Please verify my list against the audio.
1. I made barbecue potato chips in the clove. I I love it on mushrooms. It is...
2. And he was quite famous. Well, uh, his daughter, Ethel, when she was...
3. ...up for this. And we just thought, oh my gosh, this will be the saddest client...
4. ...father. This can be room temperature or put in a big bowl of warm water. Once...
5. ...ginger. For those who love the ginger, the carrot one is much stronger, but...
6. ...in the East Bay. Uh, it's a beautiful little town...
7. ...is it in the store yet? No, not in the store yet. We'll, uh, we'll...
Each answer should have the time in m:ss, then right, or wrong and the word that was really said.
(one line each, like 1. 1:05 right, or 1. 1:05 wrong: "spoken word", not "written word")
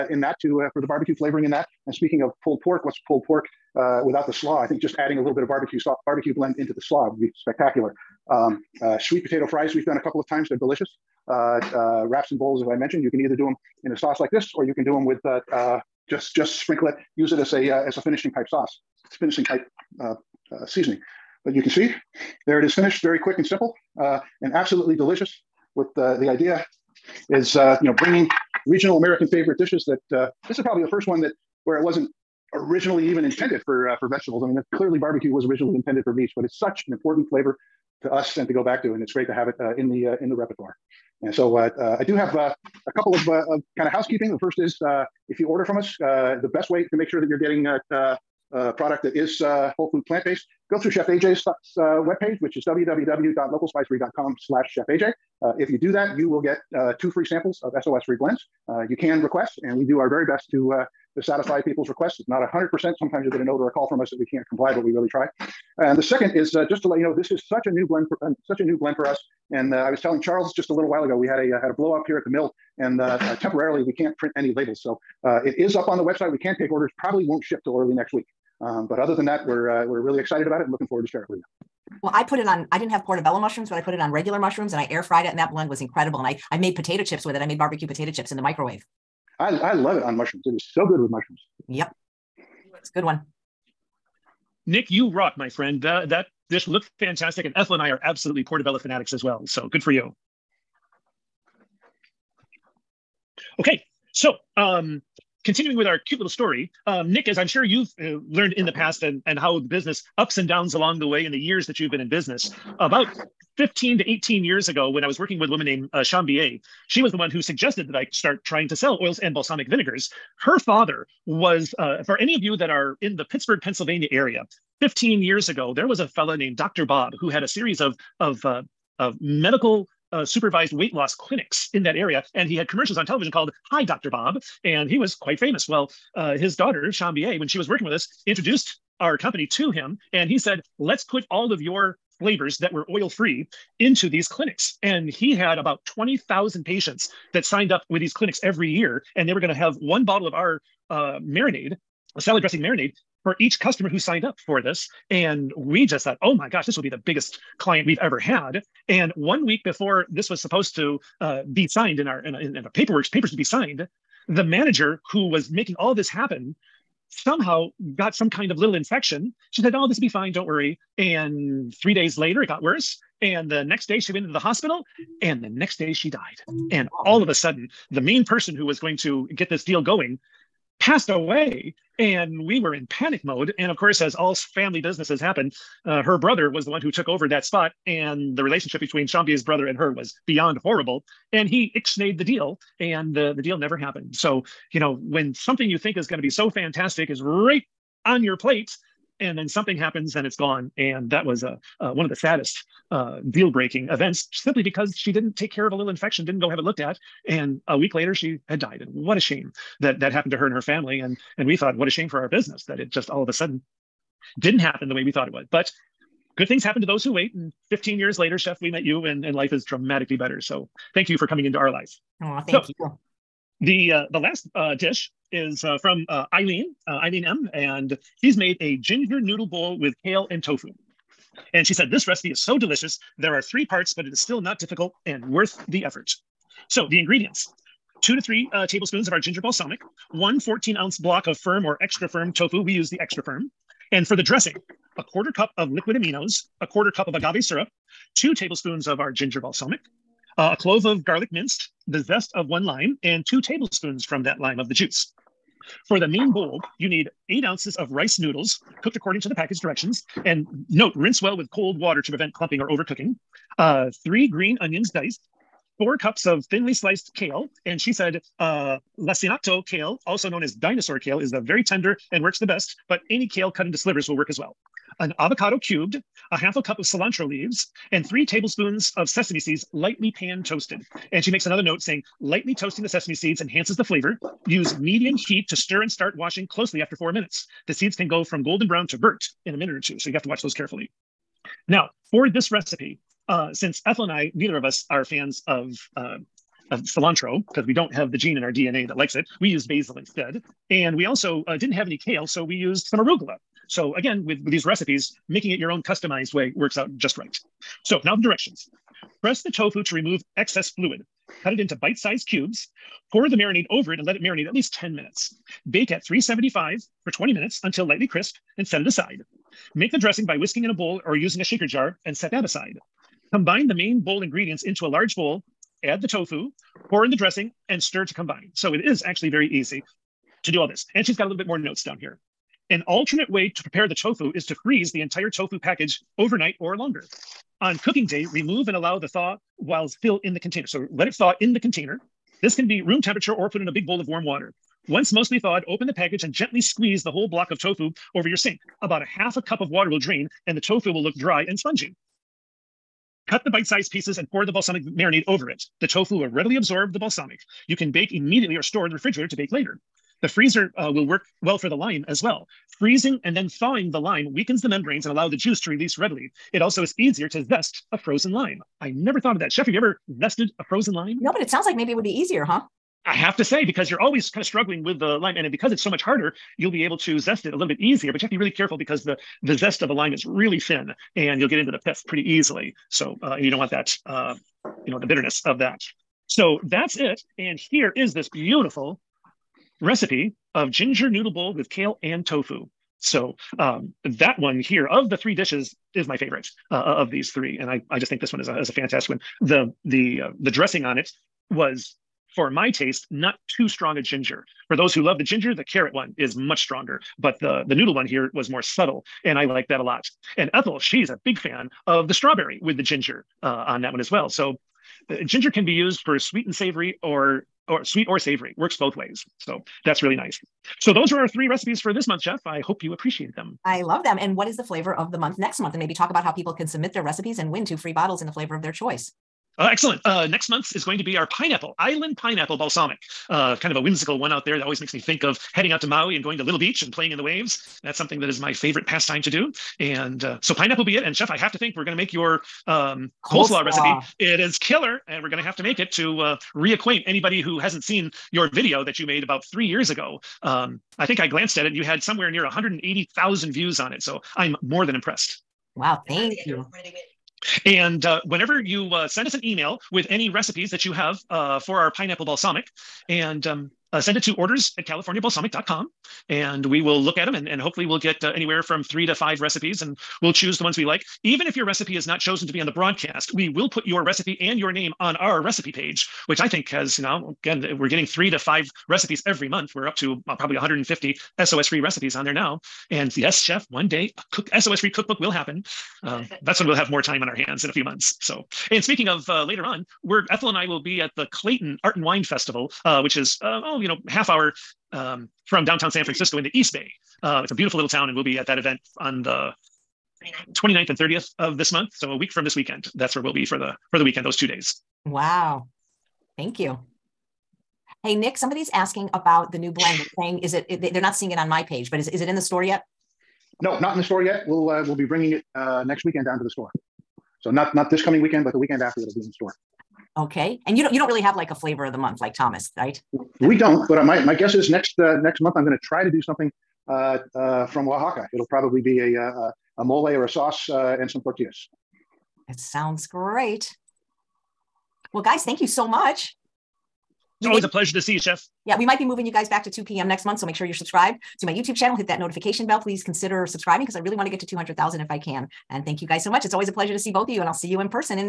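1. 1:27 wrong: "microwave", not "clove"
2. 2:14 wrong: "Chambier", not "Ethel"
3. 2:34 wrong: "biggest", not "saddest"
4. 5:41 wrong: "container", not "father"
5. 6:44 right
6. 8:16 right
7. 8:32 right.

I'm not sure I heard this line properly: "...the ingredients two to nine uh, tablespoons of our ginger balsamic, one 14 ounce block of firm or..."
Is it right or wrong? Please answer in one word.
wrong.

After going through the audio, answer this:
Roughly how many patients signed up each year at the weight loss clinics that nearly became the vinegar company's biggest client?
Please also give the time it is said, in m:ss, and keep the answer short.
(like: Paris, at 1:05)
20,000, at 2:25.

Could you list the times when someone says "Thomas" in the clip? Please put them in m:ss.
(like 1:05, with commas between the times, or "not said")
8:42.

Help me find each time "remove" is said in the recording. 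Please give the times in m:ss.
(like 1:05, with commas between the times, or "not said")
5:09, 5:38.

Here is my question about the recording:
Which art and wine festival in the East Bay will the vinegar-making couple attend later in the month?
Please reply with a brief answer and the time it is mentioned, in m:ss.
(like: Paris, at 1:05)
Clayton Art and Wine Festival, at 8:11.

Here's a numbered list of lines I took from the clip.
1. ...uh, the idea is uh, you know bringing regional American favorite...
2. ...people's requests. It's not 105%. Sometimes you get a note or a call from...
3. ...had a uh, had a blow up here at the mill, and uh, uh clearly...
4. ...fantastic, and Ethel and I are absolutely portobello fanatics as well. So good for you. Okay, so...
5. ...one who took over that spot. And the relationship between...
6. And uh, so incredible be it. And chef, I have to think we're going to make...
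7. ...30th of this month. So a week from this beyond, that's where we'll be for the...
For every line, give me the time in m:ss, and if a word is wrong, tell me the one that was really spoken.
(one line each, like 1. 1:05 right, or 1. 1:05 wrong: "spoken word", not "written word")
1. 0:25 right
2. 1:01 wrong: "100", not "105"
3. 1:11 wrong: "temporarily", not "clearly"
4. 1:36 right
5. 3:06 right
6. 7:19 wrong: "pineapple", not "incredible"
7. 8:20 wrong: "weekend", not "beyond".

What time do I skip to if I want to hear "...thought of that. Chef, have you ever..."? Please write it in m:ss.
6:09.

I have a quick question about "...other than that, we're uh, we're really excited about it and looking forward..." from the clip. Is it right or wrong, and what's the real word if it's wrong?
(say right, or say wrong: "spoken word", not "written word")
right.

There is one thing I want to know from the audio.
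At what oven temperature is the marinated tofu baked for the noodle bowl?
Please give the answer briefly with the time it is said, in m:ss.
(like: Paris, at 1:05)
375, at 5:16.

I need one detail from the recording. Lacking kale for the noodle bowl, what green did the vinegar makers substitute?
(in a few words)
arugula.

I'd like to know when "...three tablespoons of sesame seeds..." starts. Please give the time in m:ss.
4:38.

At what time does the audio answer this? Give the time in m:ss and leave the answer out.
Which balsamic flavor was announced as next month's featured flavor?
7:11.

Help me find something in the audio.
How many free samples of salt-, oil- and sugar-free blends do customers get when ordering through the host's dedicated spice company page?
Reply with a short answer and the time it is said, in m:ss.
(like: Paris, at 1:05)
2, at 0:56.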